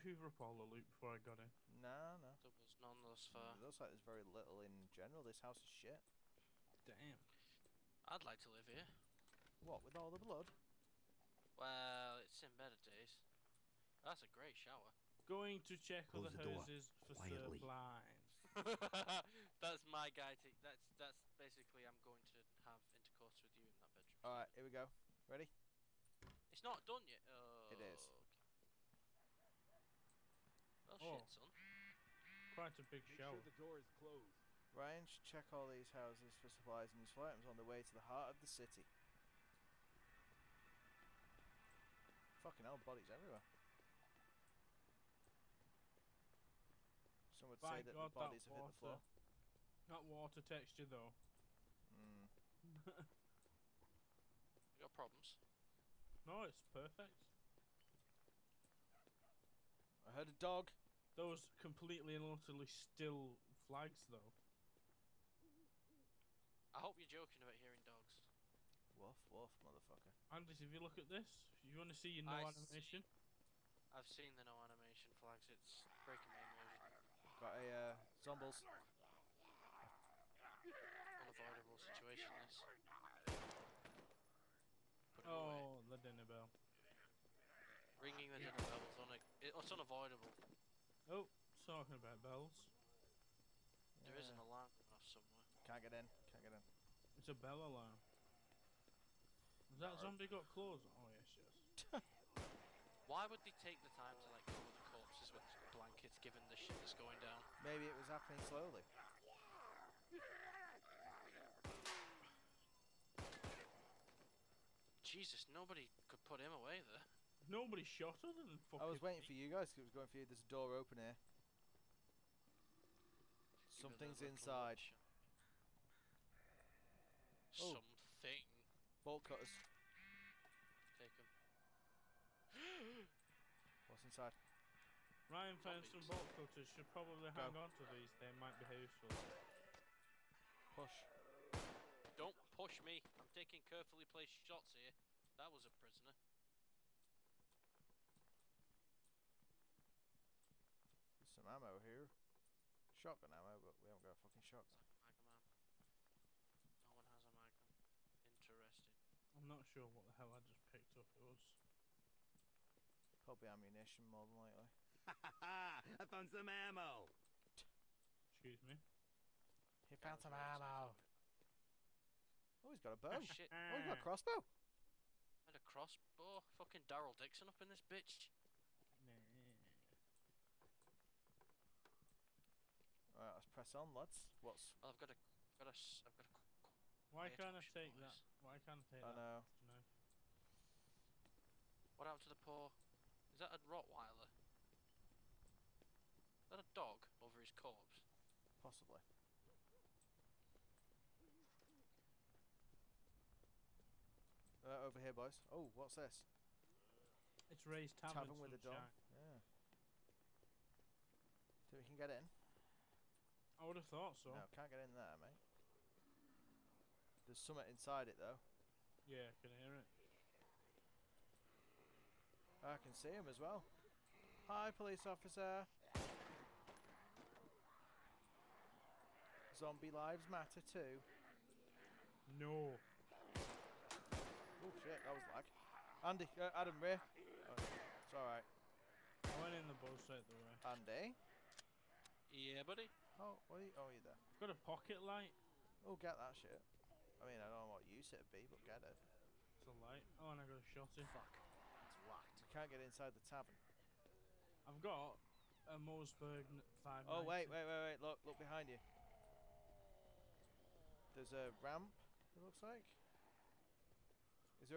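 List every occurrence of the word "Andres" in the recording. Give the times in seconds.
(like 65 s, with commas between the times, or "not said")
70 s.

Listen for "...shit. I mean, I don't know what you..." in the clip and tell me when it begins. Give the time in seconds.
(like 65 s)
246 s.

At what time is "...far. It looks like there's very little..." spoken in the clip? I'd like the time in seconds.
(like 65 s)
3 s.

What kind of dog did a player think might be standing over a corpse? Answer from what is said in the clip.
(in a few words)
Rottweiler.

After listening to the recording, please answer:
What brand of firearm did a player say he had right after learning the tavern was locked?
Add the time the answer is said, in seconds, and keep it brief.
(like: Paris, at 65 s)
Mossberg, at 255 s.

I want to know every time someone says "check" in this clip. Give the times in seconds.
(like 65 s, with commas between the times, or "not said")
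15 s, 35 s.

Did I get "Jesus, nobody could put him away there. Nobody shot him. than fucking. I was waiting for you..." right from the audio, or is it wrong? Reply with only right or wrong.
right.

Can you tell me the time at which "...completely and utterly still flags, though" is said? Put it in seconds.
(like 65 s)
61 s.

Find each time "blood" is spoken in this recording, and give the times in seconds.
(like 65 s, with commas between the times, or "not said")
10 s.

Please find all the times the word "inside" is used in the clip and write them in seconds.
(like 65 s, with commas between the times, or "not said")
124 s, 134 s, 217 s, 252 s.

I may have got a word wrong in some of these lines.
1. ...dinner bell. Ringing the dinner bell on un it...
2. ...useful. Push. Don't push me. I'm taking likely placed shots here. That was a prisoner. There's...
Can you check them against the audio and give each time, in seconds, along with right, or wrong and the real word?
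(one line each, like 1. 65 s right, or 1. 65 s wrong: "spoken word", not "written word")
1. 85 s right
2. 138 s wrong: "carefully", not "likely".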